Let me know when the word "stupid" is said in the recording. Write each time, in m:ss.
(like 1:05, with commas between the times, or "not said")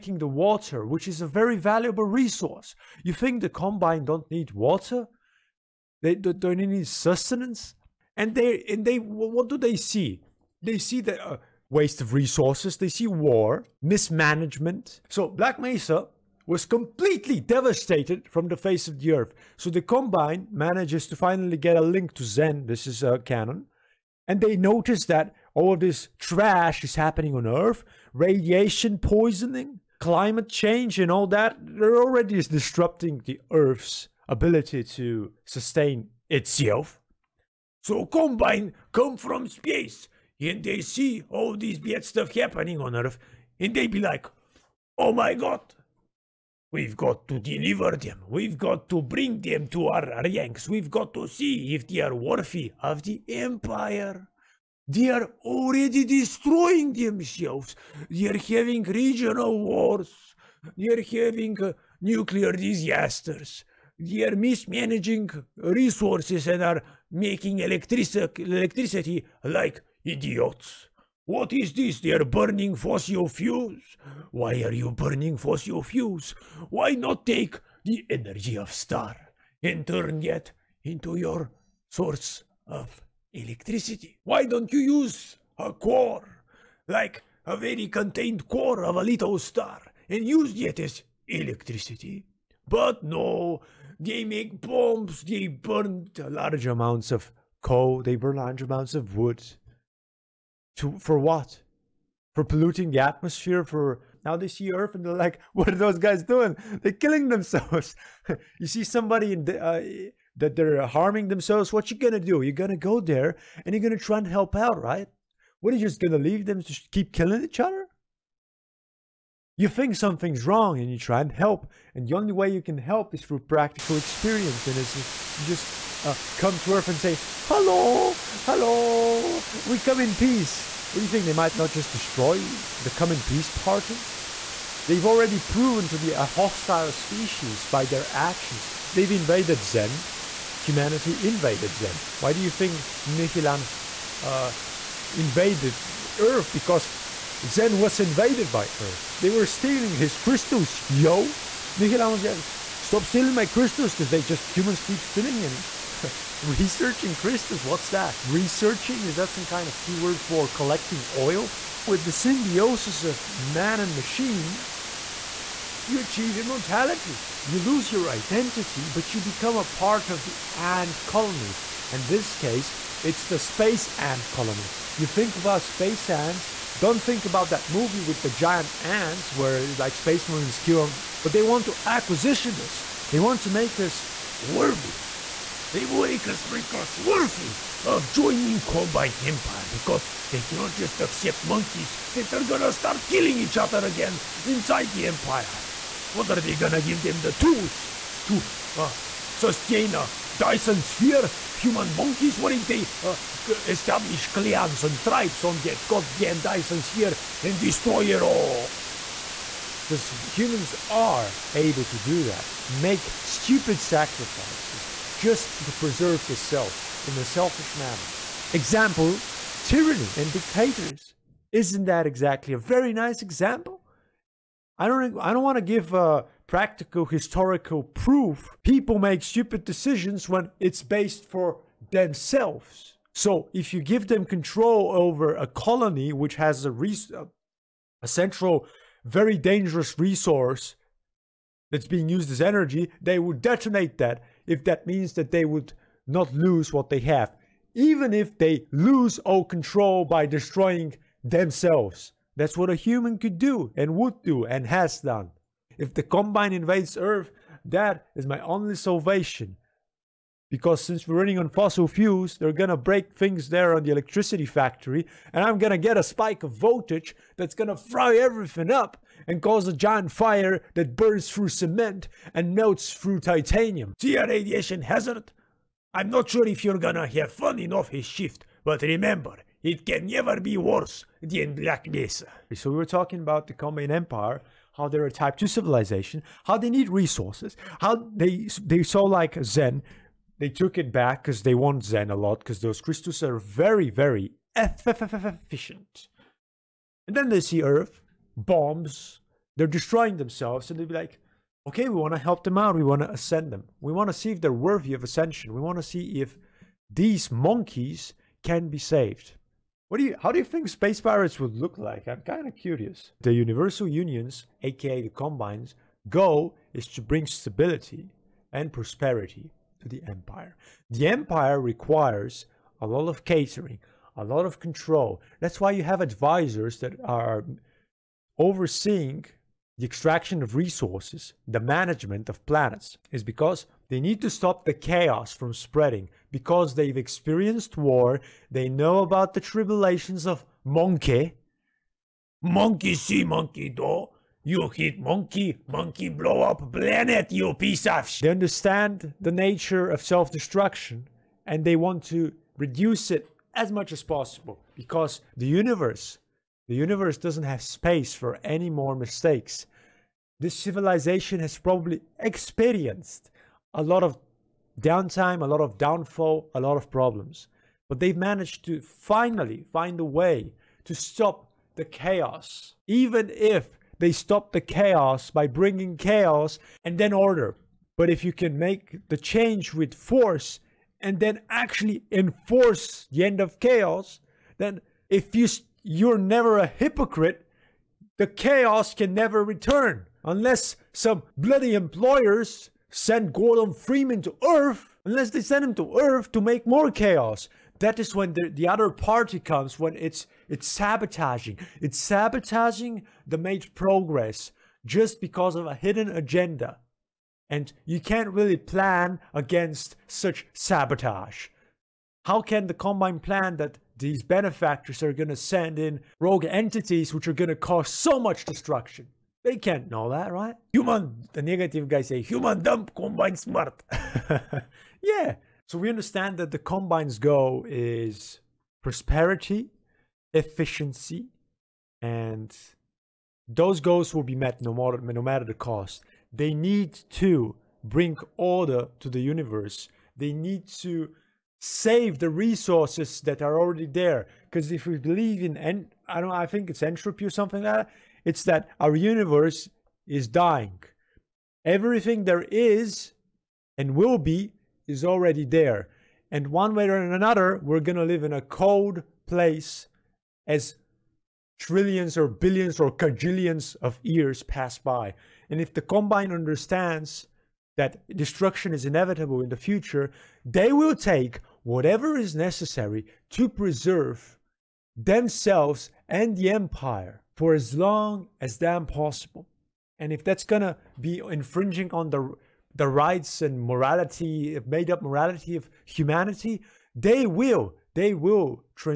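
3:33, 3:49.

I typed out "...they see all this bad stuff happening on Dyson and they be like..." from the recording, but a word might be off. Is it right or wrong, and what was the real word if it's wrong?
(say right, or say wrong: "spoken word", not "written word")
wrong: "Earth", not "Dyson".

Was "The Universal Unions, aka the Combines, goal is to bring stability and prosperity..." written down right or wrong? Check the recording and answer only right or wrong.
right.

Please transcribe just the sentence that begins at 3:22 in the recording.
What if they uh, establish clans and tribes on that goddamn Dyson sphere and destroy it all?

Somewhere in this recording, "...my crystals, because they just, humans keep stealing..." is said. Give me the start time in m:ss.
2:33.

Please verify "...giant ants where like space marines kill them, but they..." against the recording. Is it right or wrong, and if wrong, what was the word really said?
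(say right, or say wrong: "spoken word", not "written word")
right.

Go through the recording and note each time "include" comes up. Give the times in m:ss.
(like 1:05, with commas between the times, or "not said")
not said.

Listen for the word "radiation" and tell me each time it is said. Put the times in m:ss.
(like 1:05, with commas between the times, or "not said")
0:28, 4:34.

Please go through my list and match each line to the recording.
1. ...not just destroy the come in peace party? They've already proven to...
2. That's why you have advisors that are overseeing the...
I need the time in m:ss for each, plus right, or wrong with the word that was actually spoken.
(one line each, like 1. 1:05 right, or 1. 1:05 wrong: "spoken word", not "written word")
1. 2:11 right
2. 5:25 right.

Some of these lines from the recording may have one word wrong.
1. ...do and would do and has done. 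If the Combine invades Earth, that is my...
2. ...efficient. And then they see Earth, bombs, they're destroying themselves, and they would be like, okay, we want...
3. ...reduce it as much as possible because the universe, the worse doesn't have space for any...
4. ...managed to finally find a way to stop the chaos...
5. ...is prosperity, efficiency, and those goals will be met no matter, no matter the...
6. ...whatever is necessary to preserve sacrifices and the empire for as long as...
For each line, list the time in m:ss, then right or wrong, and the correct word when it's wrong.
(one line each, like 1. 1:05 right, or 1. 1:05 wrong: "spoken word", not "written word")
1. 4:13 right
2. 4:54 right
3. 5:52 wrong: "universe", not "worse"
4. 6:08 right
5. 7:07 right
6. 7:51 wrong: "themselves", not "sacrifices".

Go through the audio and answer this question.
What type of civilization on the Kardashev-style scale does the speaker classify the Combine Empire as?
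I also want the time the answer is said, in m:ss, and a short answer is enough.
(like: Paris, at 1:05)
Type 2, at 4:45.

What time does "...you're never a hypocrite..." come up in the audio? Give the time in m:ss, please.
6:25.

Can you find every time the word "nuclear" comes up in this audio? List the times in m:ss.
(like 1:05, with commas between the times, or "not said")
1:02.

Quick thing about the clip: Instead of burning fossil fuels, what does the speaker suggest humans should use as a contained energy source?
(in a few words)
A little star.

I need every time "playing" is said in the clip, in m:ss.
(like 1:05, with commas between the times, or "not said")
not said.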